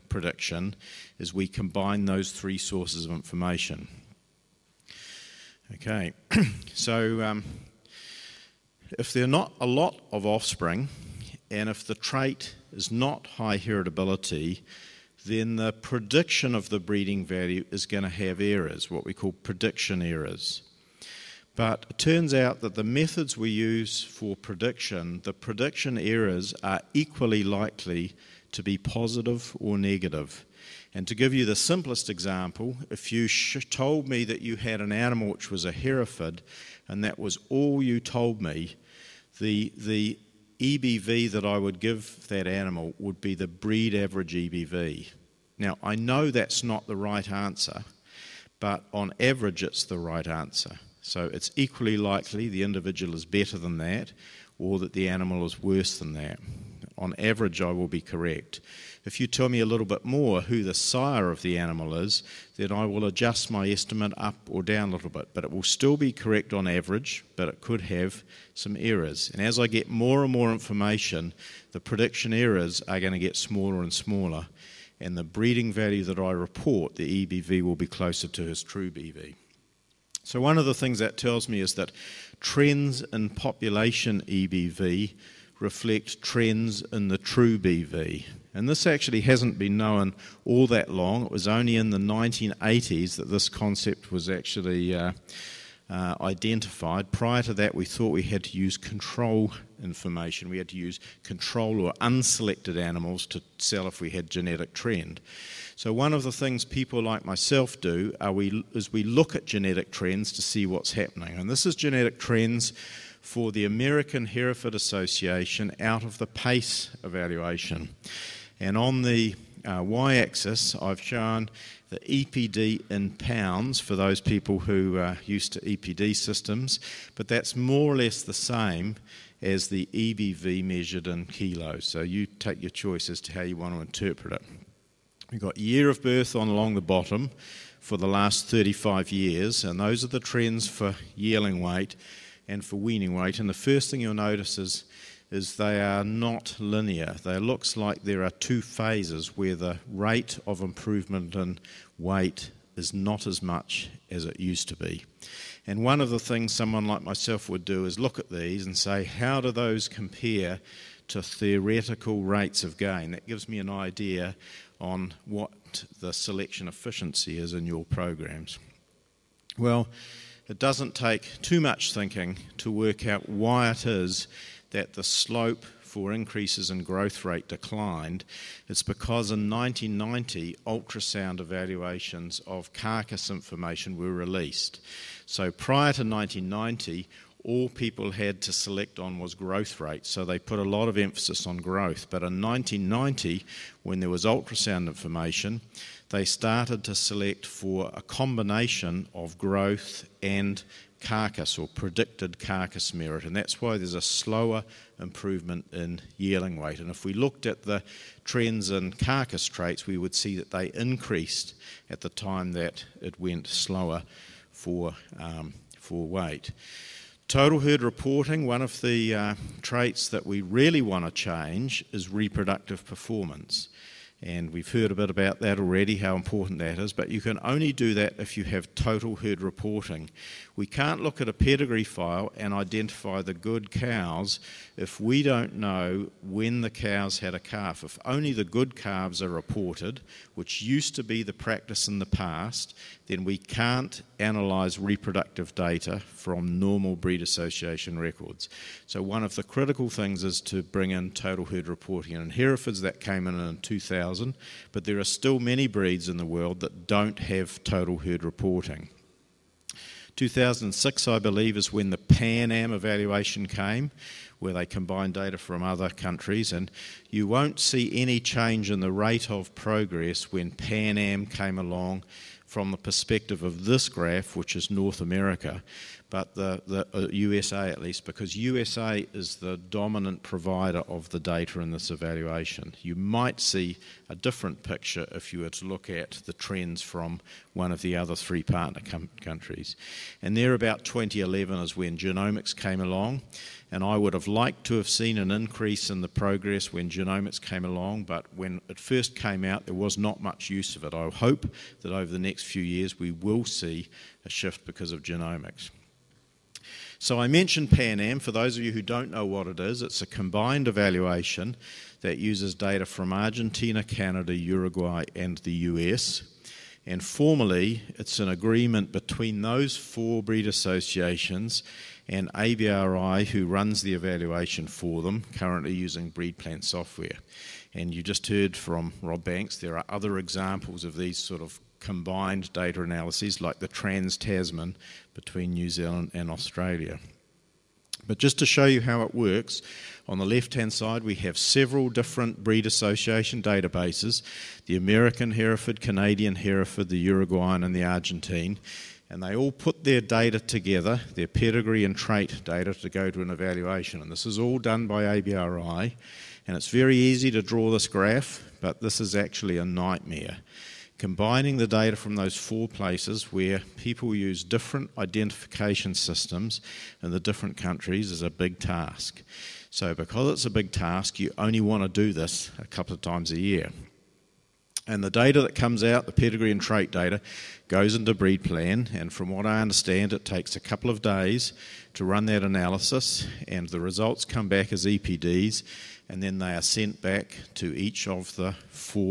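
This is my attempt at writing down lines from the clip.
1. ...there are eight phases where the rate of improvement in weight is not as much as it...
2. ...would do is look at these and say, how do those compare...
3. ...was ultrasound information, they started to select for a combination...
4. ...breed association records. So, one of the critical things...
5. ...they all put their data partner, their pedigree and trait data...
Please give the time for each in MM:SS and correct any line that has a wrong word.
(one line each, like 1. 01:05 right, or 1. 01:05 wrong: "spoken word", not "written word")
1. 02:28 wrong: "two", not "eight"
2. 02:37 right
3. 03:14 right
4. 04:06 right
5. 05:49 wrong: "together", not "partner".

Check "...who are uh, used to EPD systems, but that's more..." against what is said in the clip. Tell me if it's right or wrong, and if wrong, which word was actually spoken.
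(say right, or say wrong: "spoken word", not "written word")
right.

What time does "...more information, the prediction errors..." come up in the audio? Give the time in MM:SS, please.
01:10.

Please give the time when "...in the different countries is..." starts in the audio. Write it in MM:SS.
06:07.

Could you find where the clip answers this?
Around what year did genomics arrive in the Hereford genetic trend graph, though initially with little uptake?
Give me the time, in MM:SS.
04:50.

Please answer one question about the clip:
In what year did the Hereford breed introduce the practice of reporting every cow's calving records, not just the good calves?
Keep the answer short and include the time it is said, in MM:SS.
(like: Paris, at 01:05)
2000, at 04:13.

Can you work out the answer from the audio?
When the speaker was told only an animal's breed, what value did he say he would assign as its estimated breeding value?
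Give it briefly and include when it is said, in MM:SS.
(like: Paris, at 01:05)
Breed average EBV, at 00:43.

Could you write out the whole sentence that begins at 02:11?
So you take your choice as to how you want to interpret it.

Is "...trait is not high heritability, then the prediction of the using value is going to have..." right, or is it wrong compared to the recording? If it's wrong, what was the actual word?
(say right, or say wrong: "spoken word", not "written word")
wrong: "breeding", not "using".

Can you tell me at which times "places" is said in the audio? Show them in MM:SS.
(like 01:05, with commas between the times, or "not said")
06:02.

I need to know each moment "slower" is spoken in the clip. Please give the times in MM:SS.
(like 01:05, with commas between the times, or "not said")
03:24, 03:33.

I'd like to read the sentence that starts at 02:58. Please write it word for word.
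It's because in 1990, ultrasound evaluations of carcass information were released.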